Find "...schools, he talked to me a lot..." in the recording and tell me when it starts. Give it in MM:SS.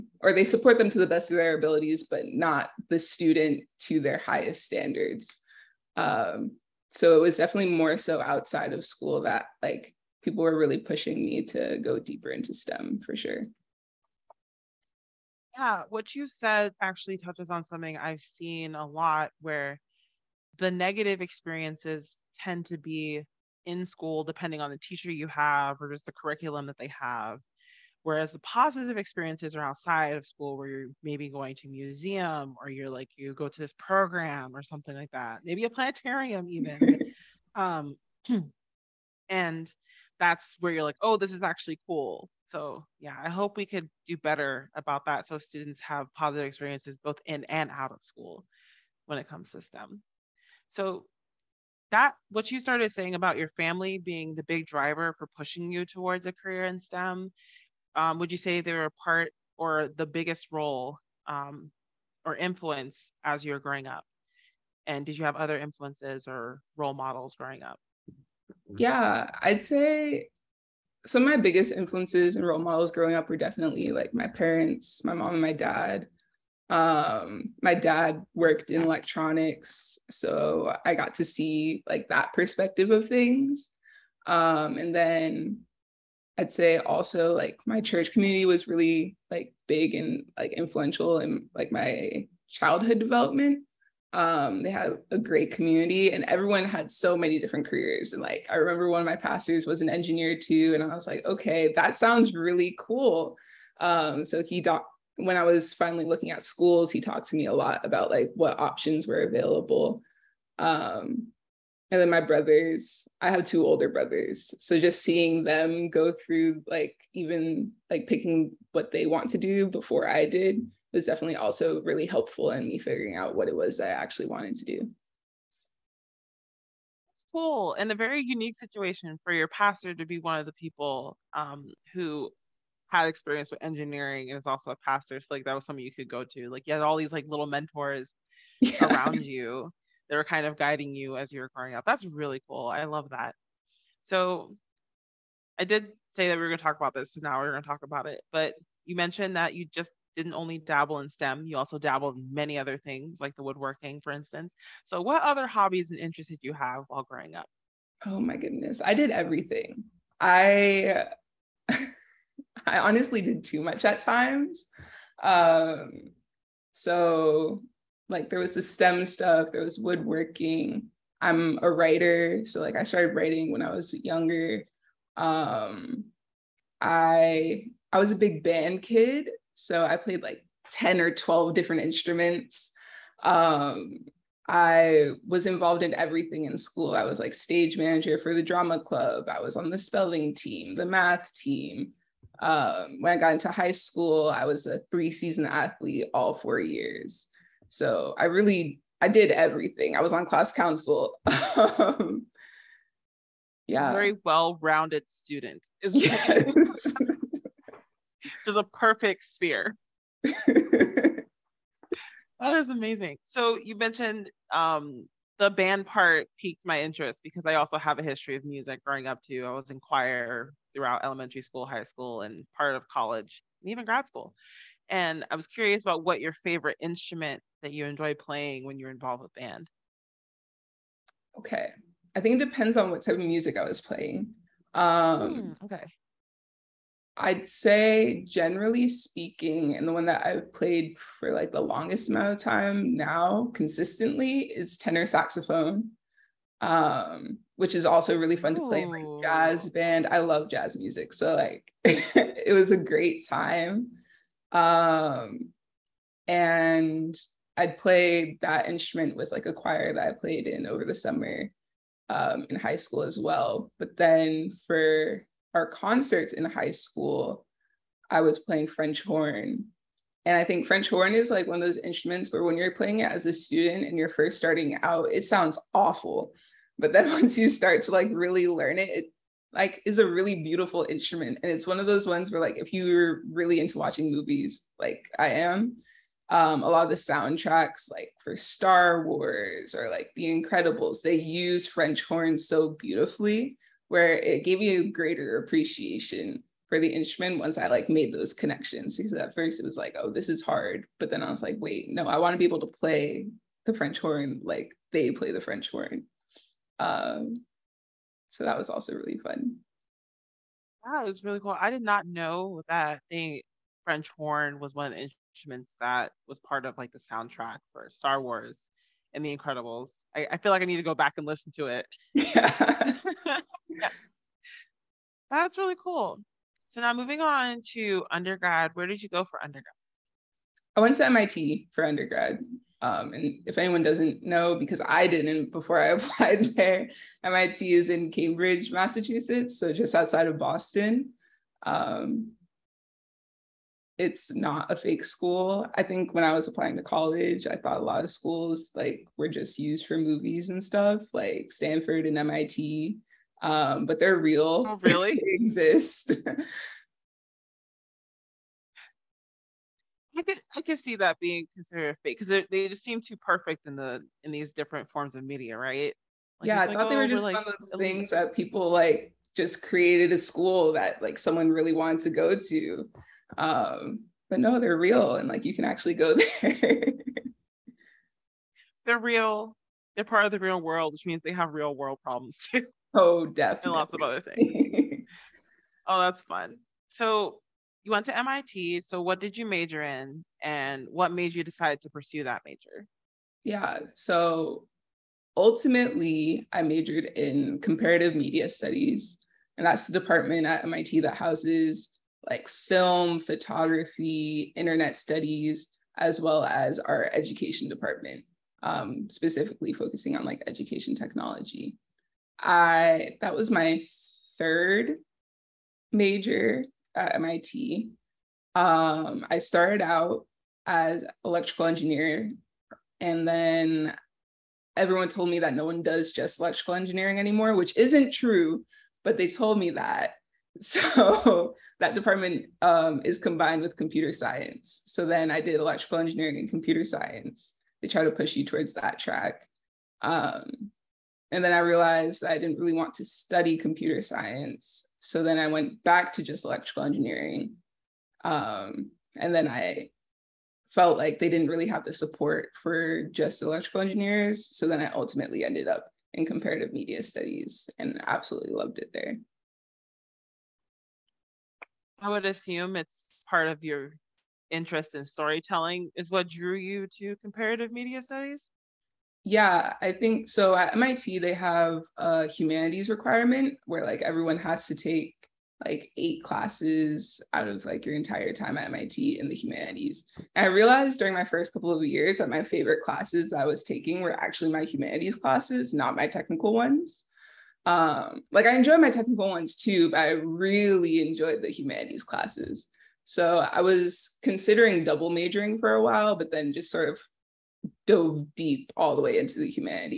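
01:46.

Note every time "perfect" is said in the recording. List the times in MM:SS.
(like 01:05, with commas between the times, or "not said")
03:28, 06:03.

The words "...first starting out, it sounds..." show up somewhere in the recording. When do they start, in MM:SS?
04:34.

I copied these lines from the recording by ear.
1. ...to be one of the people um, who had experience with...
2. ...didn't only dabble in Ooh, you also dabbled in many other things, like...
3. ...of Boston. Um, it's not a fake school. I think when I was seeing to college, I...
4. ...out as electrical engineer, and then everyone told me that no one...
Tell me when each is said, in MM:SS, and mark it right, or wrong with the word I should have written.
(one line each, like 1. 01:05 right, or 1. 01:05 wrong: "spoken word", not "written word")
1. 02:09 right
2. 02:30 wrong: "STEM", not "Ooh"
3. 05:40 wrong: "applying", not "seeing"
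4. 06:59 right.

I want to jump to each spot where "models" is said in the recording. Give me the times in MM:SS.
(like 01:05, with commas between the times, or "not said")
01:06, 01:12.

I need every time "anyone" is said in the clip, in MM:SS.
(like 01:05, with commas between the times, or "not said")
05:33.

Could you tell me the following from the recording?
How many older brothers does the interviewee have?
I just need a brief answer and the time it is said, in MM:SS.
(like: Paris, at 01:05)
2, at 01:53.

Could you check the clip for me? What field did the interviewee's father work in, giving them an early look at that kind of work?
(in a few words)
Electronics.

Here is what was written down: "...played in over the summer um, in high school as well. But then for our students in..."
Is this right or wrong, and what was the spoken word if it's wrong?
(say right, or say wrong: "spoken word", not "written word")
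wrong: "concerts", not "students".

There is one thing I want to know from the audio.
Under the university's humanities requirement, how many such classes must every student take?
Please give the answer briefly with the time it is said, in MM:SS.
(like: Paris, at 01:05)
8, at 07:55.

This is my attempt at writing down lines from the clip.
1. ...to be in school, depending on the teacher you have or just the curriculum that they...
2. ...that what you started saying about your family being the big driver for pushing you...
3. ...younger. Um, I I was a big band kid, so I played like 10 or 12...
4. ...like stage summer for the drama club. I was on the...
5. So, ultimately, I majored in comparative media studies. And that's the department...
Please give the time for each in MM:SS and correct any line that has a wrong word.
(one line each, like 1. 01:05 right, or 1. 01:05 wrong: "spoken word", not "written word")
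1. 00:22 right
2. 00:51 right
3. 02:54 right
4. 03:07 wrong: "manager", not "summer"
5. 06:33 right.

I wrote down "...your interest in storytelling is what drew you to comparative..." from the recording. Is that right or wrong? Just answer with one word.
right.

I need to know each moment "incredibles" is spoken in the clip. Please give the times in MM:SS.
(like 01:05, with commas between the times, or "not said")
04:50, 05:19.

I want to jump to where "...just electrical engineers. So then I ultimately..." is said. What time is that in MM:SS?
07:33.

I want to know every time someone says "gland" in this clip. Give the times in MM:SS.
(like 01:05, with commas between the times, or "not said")
not said.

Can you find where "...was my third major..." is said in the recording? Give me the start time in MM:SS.
06:53.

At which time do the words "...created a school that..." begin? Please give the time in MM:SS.
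06:09.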